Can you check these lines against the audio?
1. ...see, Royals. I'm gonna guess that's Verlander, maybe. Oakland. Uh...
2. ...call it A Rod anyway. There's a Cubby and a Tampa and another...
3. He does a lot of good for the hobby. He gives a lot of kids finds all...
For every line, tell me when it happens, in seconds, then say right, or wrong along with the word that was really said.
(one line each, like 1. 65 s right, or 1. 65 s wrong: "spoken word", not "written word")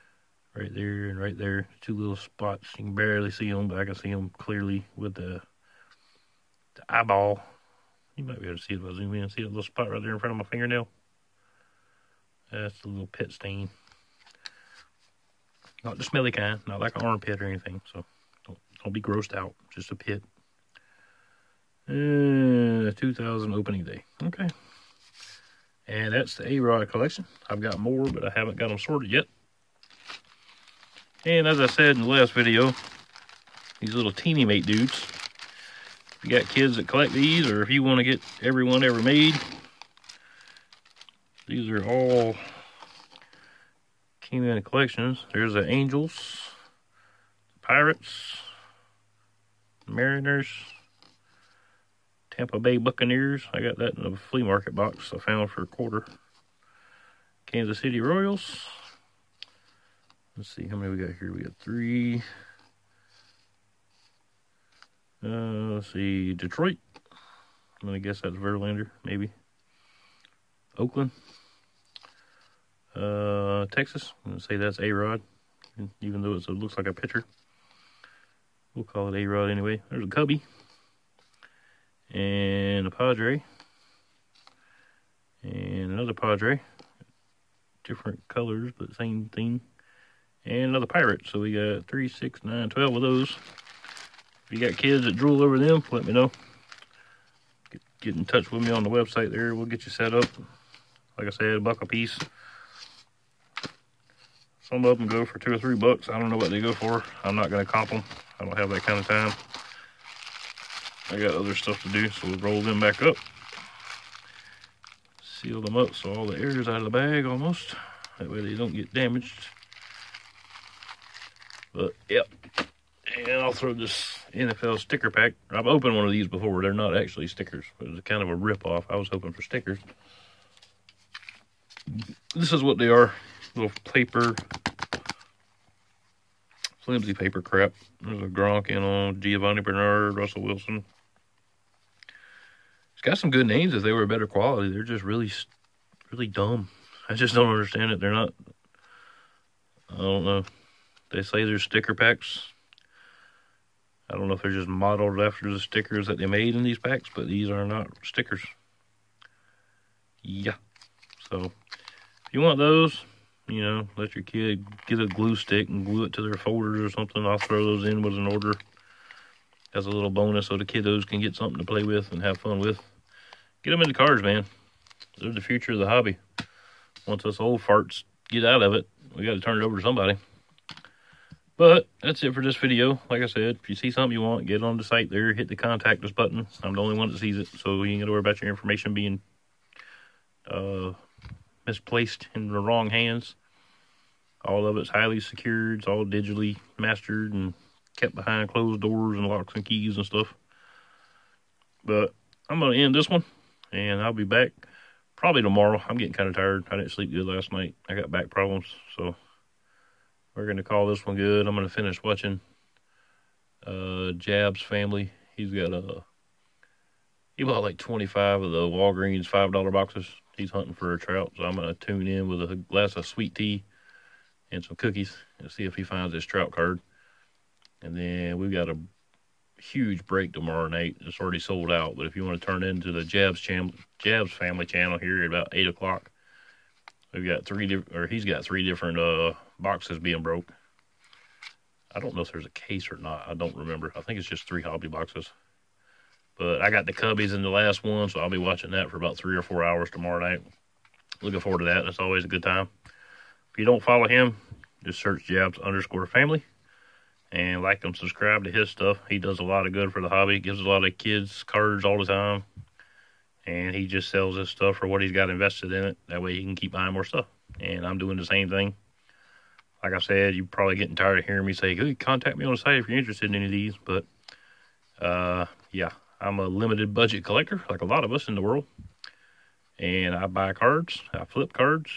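1. 65 s wrong: "Detroit", not "Royals"
2. 78 s wrong: "Padre", not "Tampa"
3. 259 s wrong: "cards", not "finds".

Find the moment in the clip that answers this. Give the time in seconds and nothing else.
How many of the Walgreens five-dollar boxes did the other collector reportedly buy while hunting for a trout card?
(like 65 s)
217 s.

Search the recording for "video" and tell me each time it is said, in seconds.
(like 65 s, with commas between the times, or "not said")
32 s, 182 s.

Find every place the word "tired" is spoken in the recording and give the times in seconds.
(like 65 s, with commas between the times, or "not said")
206 s, 270 s.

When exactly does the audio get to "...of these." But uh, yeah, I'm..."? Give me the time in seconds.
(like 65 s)
273 s.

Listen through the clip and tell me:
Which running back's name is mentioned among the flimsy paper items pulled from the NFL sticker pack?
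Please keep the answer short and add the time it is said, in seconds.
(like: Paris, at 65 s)
Giovani Bernard, at 139 s.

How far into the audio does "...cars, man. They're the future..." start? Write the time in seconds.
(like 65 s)
173 s.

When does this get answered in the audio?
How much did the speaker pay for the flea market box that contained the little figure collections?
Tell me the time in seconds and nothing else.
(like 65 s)
55 s.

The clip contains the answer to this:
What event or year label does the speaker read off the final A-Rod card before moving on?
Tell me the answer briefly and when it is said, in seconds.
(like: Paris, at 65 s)
2000 opening day, at 22 s.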